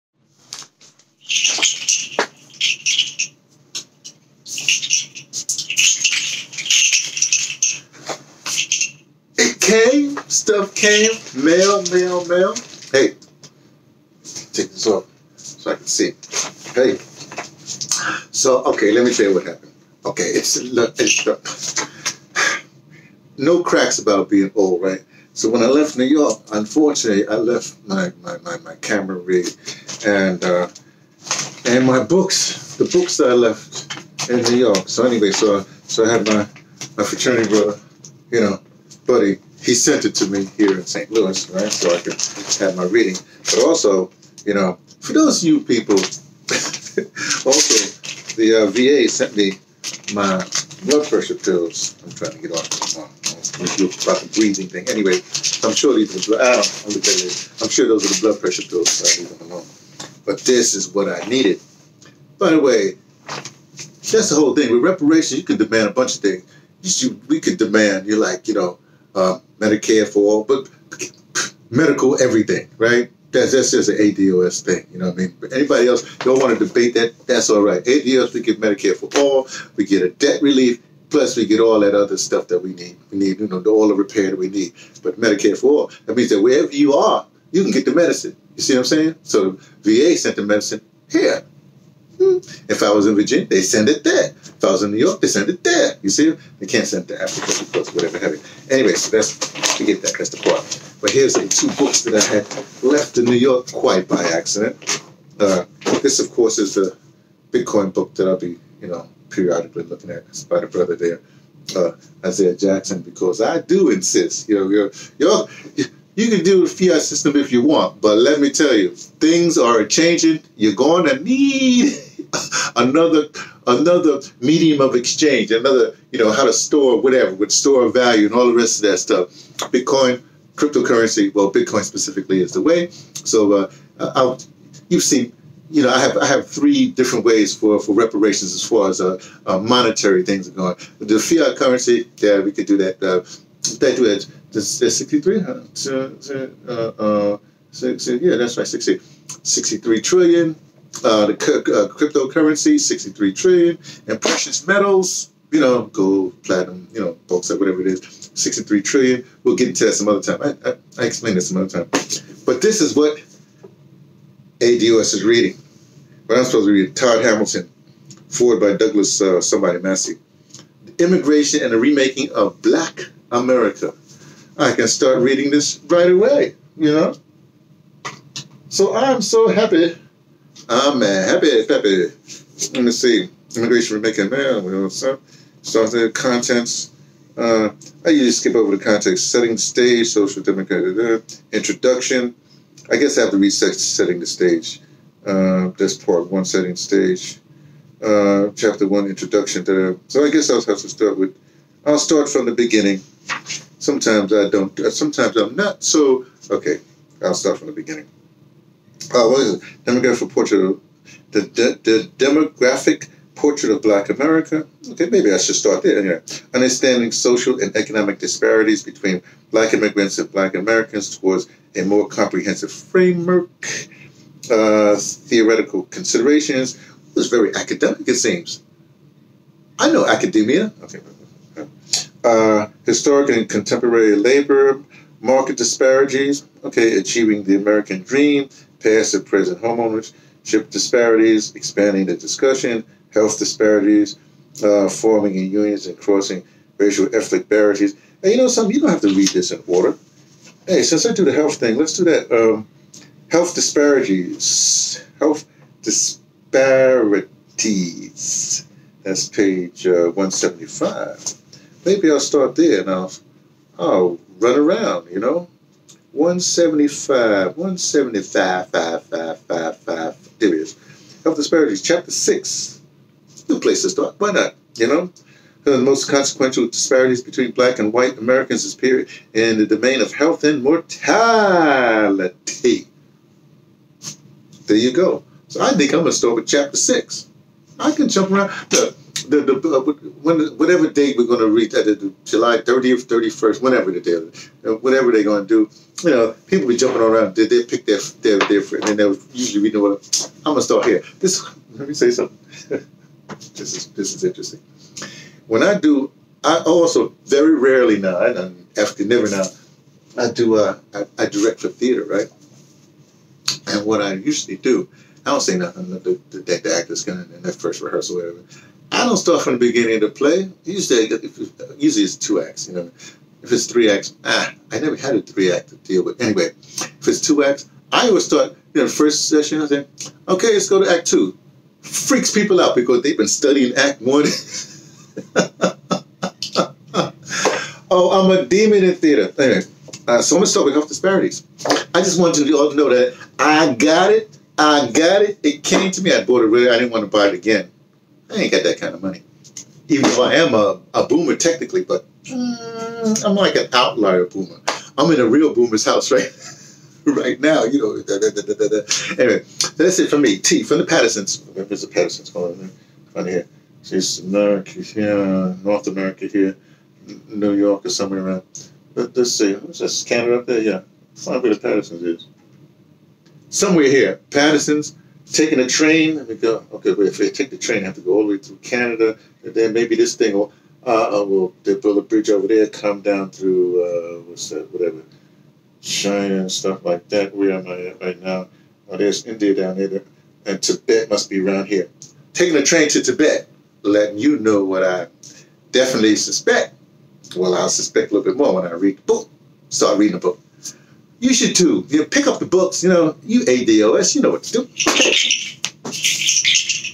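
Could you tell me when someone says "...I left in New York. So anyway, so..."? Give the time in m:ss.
0:33.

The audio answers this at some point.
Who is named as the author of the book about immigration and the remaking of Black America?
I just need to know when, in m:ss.
2:46.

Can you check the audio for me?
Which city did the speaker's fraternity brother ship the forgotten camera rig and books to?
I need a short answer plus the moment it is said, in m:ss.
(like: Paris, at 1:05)
St. Louis, at 0:40.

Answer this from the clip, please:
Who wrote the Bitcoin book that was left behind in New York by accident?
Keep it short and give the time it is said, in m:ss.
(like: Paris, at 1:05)
Isaiah Jackson, at 1:52.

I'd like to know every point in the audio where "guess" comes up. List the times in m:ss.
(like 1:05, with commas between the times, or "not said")
3:12, 3:20.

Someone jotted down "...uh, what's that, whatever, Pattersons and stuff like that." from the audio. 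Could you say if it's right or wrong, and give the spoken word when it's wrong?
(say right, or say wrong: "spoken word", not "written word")
wrong: "China", not "Pattersons".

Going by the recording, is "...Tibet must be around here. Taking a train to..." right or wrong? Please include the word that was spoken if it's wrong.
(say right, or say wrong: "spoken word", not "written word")
right.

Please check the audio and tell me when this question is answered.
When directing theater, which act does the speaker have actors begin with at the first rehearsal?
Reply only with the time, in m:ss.
5:30.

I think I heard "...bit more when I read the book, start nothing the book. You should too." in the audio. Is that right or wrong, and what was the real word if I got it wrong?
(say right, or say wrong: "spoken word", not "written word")
wrong: "reading", not "nothing".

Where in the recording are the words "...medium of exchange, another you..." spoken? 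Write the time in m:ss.
2:04.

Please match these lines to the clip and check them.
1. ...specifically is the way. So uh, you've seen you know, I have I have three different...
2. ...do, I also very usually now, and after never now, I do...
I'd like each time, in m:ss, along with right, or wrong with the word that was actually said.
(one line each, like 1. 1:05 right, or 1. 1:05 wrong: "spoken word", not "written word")
1. 2:11 right
2. 5:05 wrong: "rarely", not "usually".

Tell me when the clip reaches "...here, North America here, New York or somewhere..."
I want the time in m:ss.
6:04.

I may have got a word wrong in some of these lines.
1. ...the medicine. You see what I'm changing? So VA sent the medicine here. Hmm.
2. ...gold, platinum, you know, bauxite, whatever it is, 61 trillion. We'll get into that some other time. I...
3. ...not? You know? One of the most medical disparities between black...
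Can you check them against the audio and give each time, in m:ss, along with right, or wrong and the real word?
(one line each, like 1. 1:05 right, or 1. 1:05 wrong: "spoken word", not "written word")
1. 1:27 wrong: "saying", not "changing"
2. 2:35 wrong: "63", not "61"
3. 4:34 wrong: "consequential", not "medical".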